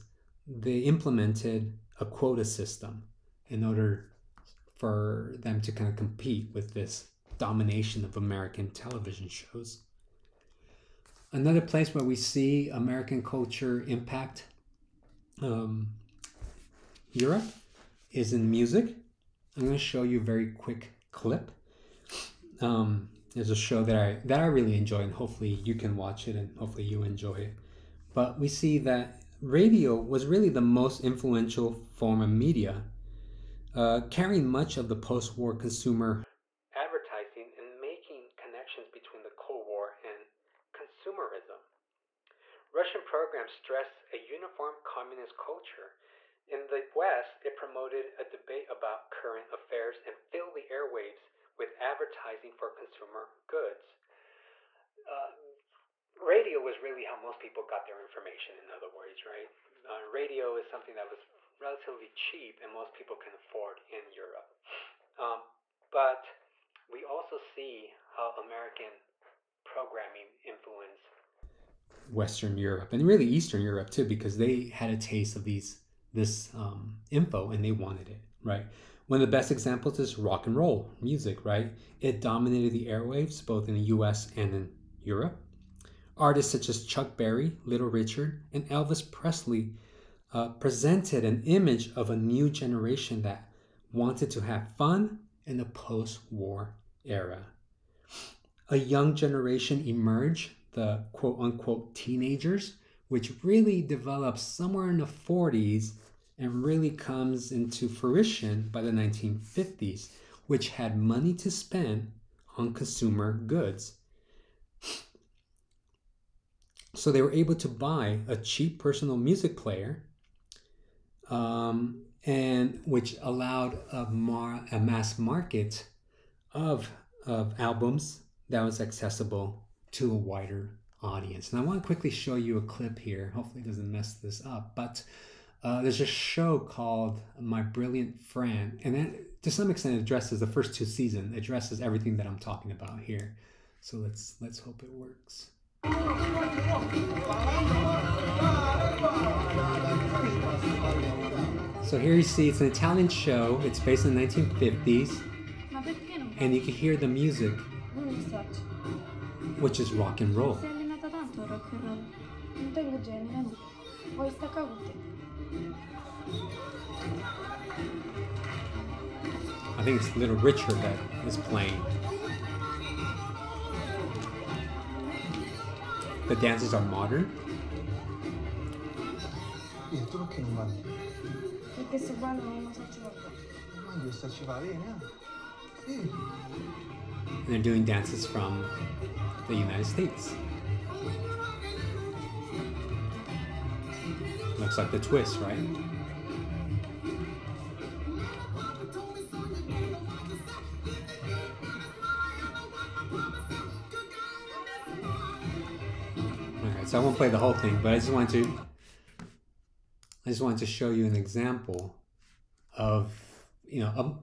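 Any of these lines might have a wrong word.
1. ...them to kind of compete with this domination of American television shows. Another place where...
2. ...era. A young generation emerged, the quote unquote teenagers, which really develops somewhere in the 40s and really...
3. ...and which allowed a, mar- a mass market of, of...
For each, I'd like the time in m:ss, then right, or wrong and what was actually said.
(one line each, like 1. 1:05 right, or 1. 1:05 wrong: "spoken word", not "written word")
1. 0:05 right
2. 1:37 right
3. 2:02 right.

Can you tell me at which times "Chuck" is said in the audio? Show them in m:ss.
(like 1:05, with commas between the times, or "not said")
1:26.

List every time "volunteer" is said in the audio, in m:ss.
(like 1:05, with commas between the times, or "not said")
not said.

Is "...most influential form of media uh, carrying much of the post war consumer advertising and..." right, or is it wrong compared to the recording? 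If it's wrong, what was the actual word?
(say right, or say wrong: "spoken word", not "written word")
right.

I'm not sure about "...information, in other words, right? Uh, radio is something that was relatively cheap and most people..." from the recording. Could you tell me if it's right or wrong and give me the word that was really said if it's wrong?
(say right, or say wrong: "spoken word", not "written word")
right.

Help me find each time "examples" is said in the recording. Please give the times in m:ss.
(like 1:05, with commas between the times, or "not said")
1:19, 3:31.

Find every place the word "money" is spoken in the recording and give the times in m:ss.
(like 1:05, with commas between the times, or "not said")
1:51.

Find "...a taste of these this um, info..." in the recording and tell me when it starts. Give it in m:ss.
1:14.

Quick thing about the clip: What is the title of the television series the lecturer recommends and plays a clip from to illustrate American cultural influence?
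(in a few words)
My Brilliant Friend.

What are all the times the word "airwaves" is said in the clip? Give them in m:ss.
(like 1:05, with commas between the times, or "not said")
0:50, 1:22.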